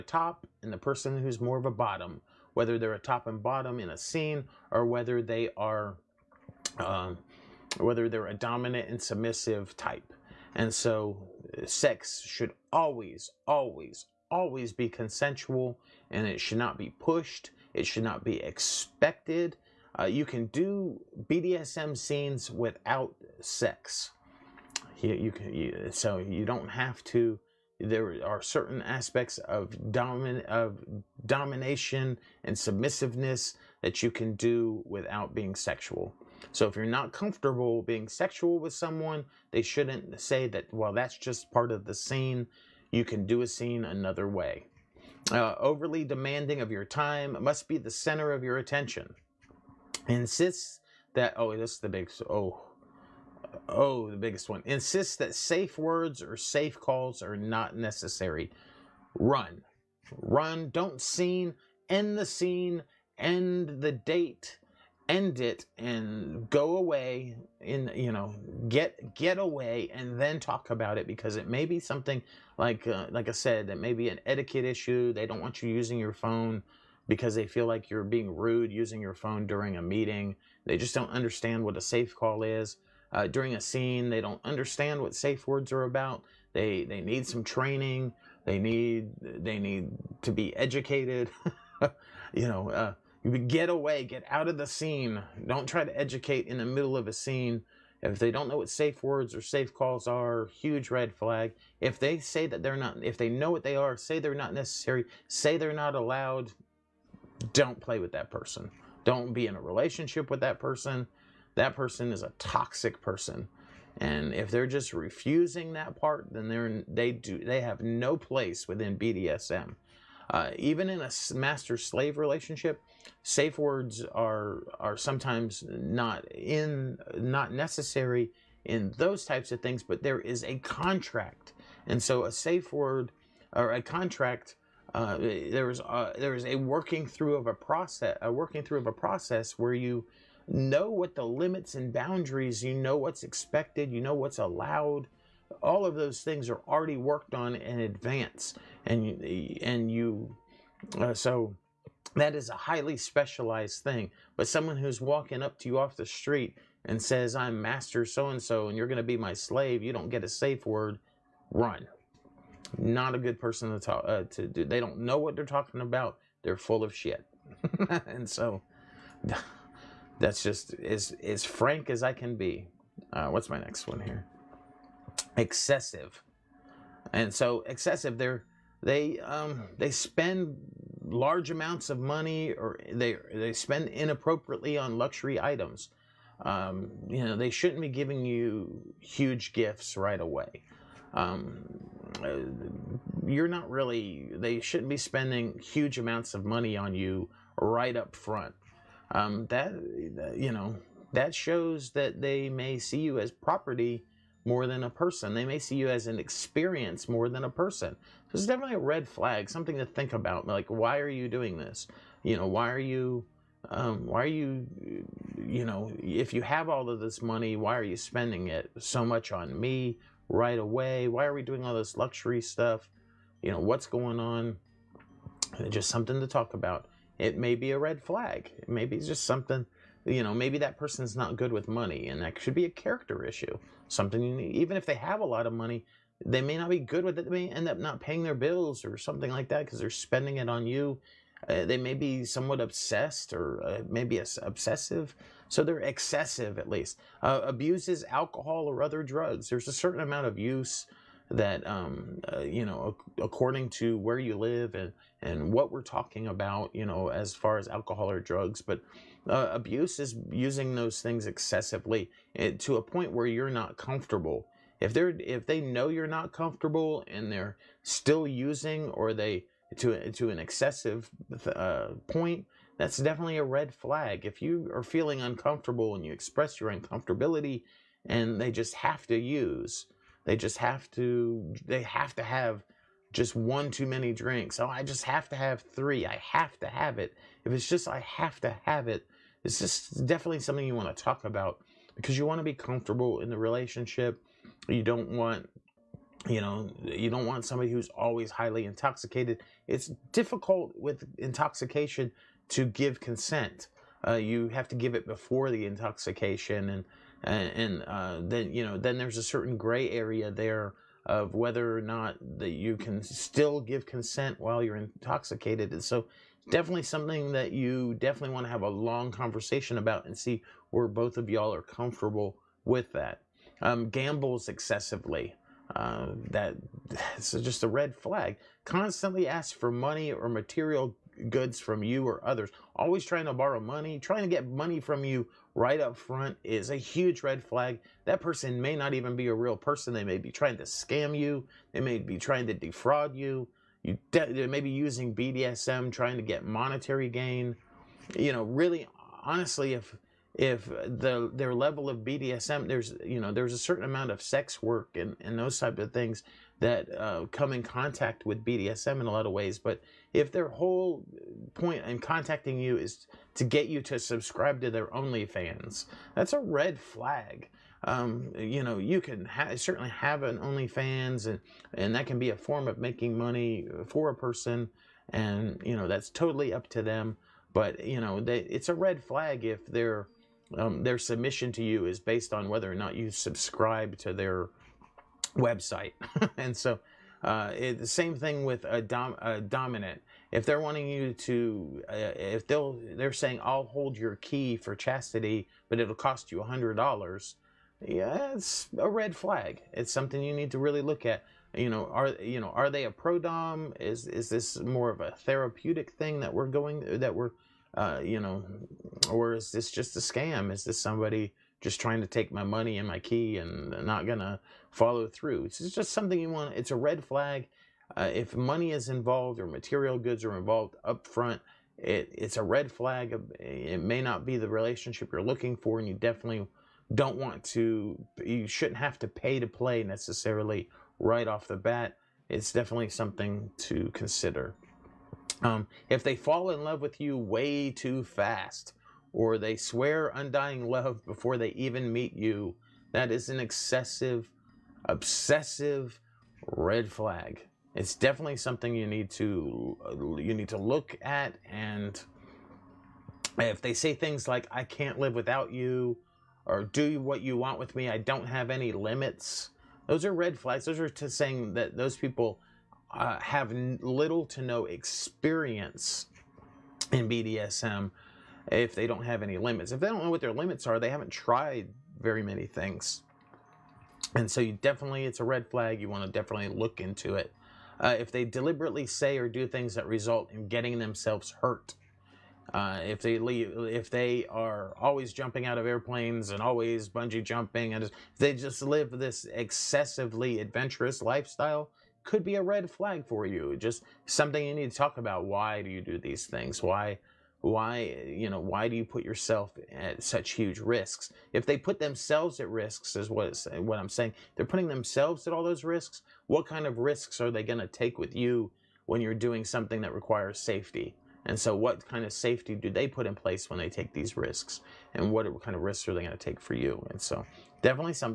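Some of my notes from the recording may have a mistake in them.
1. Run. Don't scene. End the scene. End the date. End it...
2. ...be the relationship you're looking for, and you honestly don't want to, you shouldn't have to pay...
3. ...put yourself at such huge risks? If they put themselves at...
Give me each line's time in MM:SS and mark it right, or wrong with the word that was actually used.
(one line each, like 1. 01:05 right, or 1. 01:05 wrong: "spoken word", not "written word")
1. 01:00 right
2. 07:04 wrong: "definitely", not "honestly"
3. 08:18 right.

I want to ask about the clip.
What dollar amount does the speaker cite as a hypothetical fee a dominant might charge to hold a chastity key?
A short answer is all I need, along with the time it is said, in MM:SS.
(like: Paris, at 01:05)
$100, at 06:36.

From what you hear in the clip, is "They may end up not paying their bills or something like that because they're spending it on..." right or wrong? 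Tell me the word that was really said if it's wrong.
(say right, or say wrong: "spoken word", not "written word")
right.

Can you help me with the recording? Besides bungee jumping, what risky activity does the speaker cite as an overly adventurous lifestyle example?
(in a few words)
Jumping out of airplanes.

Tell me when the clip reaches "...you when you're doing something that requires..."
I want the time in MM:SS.
08:28.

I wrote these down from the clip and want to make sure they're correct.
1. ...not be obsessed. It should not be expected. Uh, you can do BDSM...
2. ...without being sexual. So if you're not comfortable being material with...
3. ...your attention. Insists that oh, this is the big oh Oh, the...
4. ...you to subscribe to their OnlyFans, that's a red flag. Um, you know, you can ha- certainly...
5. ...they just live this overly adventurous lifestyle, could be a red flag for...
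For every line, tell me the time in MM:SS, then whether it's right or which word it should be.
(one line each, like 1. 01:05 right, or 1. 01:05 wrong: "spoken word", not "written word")
1. 00:16 wrong: "pushed", not "obsessed"
2. 00:34 wrong: "sexual", not "material"
3. 00:48 right
4. 06:03 right
5. 08:08 wrong: "excessively", not "overly".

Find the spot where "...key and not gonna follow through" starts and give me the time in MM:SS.
06:52.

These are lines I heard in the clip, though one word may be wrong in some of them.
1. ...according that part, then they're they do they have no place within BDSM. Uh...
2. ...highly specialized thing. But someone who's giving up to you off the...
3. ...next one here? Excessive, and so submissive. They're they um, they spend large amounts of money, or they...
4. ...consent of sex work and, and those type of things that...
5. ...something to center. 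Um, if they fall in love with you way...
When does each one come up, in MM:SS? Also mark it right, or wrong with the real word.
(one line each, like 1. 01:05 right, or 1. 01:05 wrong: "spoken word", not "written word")
1. 01:54 wrong: "refusing", not "according"
2. 02:32 wrong: "walking", not "giving"
3. 02:53 wrong: "excessive", not "submissive"
4. 05:53 wrong: "amount", not "consent"
5. 07:12 wrong: "consider", not "center".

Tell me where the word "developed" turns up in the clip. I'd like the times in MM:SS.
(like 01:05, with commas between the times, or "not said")
not said.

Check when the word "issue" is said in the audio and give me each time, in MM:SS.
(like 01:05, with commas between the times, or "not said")
01:14, 03:53.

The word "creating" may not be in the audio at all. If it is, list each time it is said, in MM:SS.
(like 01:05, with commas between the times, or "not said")
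not said.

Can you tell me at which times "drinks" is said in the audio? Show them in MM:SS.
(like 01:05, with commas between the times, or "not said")
04:44.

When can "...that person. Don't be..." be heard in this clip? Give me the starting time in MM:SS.
01:48.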